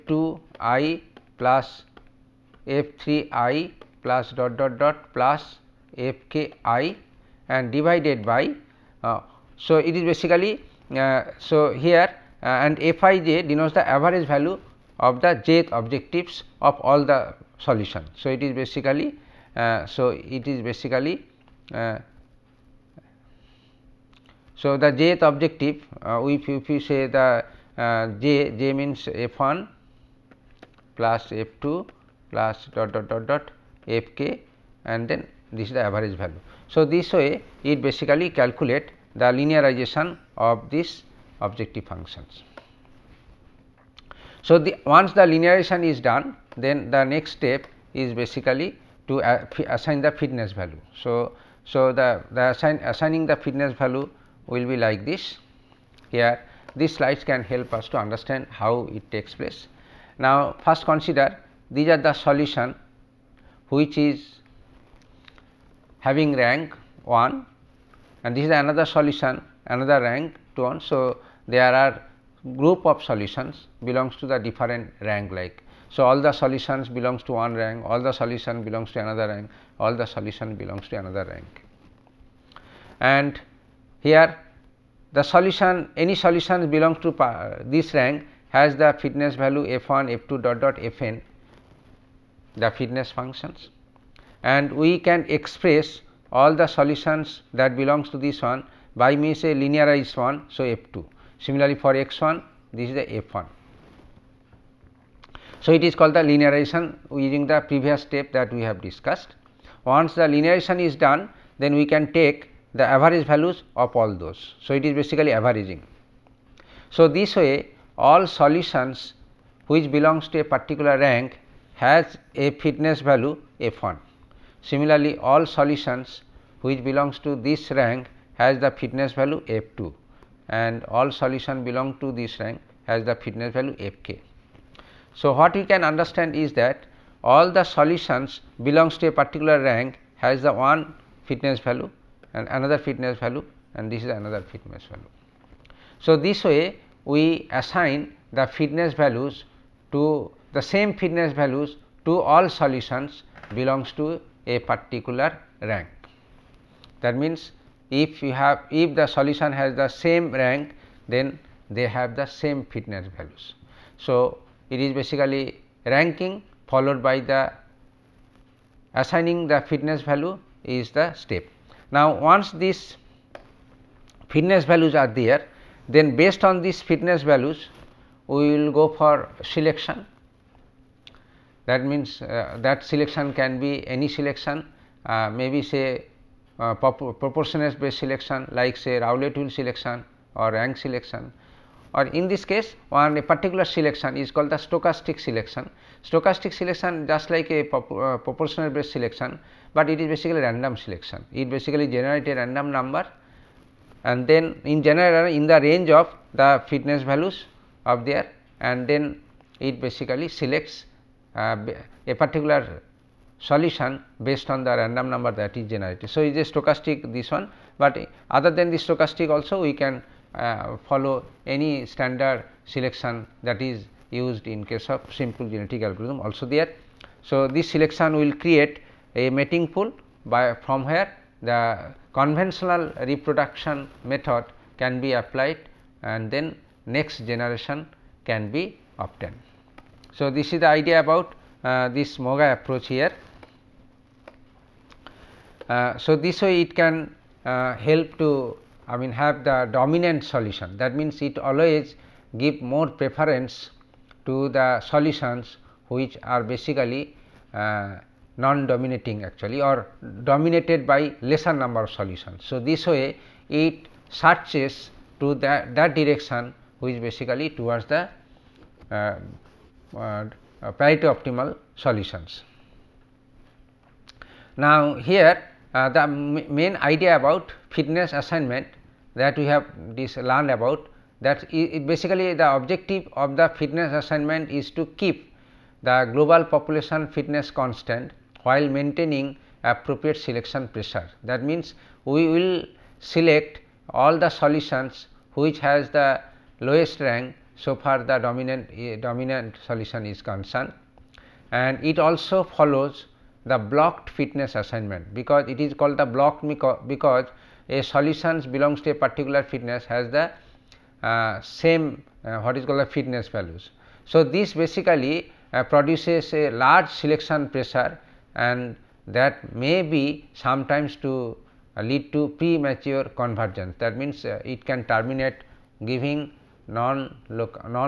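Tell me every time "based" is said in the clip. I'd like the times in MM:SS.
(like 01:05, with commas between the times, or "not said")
02:56, 03:07, 03:18, 03:34.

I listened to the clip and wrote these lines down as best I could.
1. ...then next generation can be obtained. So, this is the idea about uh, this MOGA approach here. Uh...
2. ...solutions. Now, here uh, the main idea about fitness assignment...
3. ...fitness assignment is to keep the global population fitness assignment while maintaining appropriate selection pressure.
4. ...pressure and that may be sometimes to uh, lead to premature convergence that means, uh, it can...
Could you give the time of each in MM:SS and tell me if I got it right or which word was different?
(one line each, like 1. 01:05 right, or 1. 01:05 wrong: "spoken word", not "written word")
1. 03:56 right
2. 04:31 right
3. 04:43 wrong: "constant", not "assignment"
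4. 05:17 right.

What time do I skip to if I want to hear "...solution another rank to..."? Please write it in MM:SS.
01:08.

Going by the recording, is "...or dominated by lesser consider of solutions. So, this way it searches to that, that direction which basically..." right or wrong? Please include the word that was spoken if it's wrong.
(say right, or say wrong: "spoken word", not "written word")
wrong: "number", not "consider".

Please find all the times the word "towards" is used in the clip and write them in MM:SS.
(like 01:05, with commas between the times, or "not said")
04:27.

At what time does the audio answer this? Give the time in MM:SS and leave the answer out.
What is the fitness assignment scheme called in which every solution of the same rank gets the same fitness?
05:03.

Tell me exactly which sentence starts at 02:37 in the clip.
That means, if you have if the solution has the same rank then they have the same fitness values.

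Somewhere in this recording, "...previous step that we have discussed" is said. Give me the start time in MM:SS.
01:47.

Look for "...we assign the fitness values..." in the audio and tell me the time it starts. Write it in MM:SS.
02:27.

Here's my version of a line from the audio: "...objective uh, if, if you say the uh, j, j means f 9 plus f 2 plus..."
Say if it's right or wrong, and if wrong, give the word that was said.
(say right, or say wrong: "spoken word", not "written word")
wrong: "1", not "9".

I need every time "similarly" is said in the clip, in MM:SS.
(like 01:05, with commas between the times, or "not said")
01:41, 02:04.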